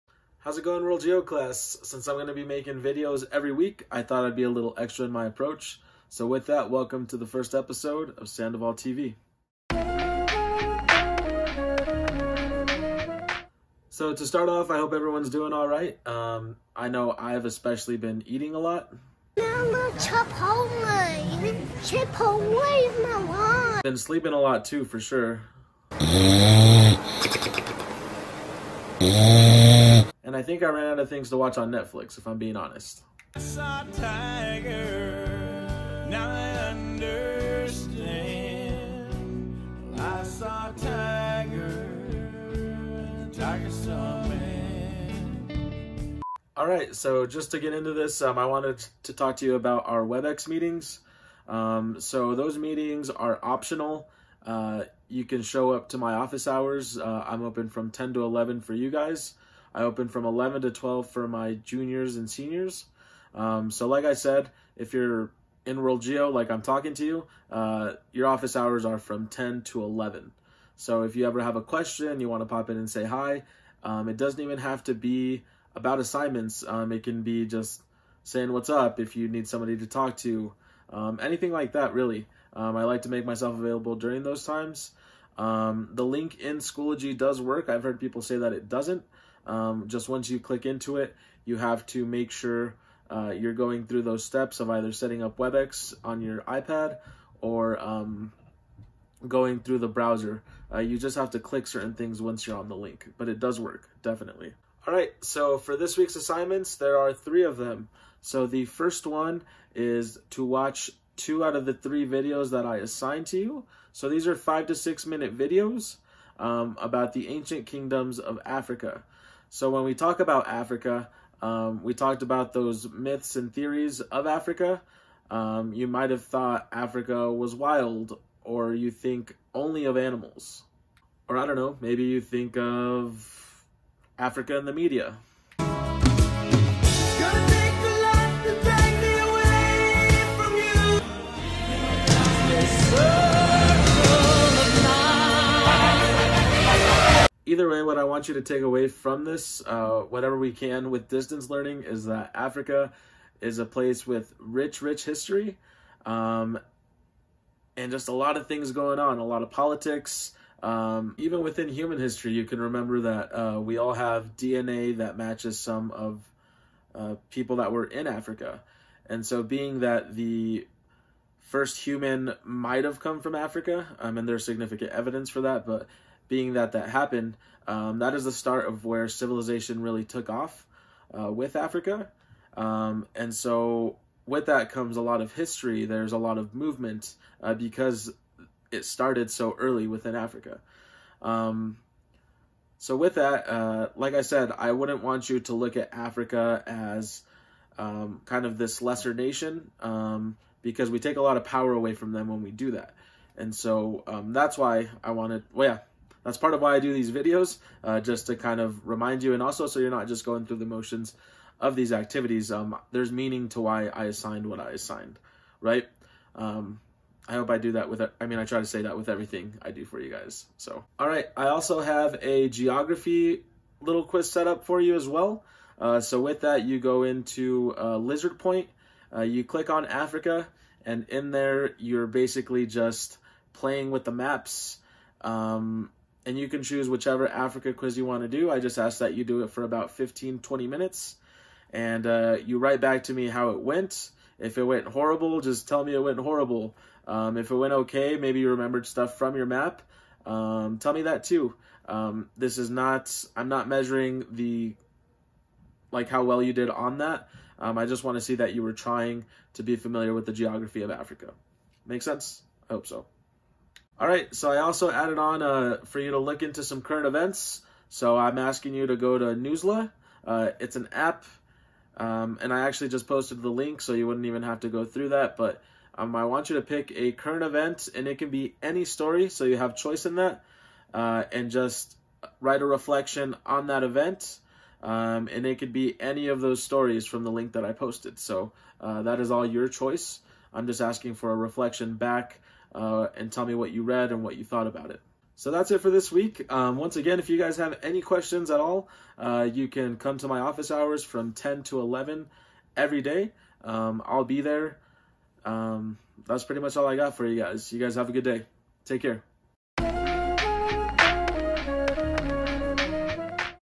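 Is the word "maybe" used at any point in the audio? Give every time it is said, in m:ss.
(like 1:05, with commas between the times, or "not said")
2:11, 4:08.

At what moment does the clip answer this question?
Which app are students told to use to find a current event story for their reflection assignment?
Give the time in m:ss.
4:29.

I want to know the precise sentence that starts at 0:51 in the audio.
Um, so those meetings are optional.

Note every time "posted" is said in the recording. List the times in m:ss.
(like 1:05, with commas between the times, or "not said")
4:33, 4:47.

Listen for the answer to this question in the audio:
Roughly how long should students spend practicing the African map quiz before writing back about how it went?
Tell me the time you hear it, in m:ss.
3:59.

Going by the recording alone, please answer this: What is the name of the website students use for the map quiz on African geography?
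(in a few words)
Lizard Point.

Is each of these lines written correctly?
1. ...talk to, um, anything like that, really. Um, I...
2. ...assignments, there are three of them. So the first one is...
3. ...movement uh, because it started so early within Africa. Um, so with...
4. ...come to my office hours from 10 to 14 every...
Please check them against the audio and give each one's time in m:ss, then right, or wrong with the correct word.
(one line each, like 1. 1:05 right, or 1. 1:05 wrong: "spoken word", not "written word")
1. 1:19 right
2. 1:46 right
3. 3:06 right
4. 4:59 wrong: "11", not "14".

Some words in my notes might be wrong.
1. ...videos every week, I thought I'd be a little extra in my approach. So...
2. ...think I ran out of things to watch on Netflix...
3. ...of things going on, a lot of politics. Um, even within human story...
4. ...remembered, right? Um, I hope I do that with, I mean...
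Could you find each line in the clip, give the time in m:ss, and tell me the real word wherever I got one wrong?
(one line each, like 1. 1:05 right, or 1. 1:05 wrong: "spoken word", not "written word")
1. 0:02 right
2. 0:30 right
3. 2:38 wrong: "history", not "story"
4. 3:34 wrong: "assigned", not "remembered".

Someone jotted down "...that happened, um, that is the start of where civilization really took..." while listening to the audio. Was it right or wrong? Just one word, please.
right.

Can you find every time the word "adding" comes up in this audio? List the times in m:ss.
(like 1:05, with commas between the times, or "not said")
not said.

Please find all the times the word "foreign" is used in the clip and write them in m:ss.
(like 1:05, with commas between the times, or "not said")
not said.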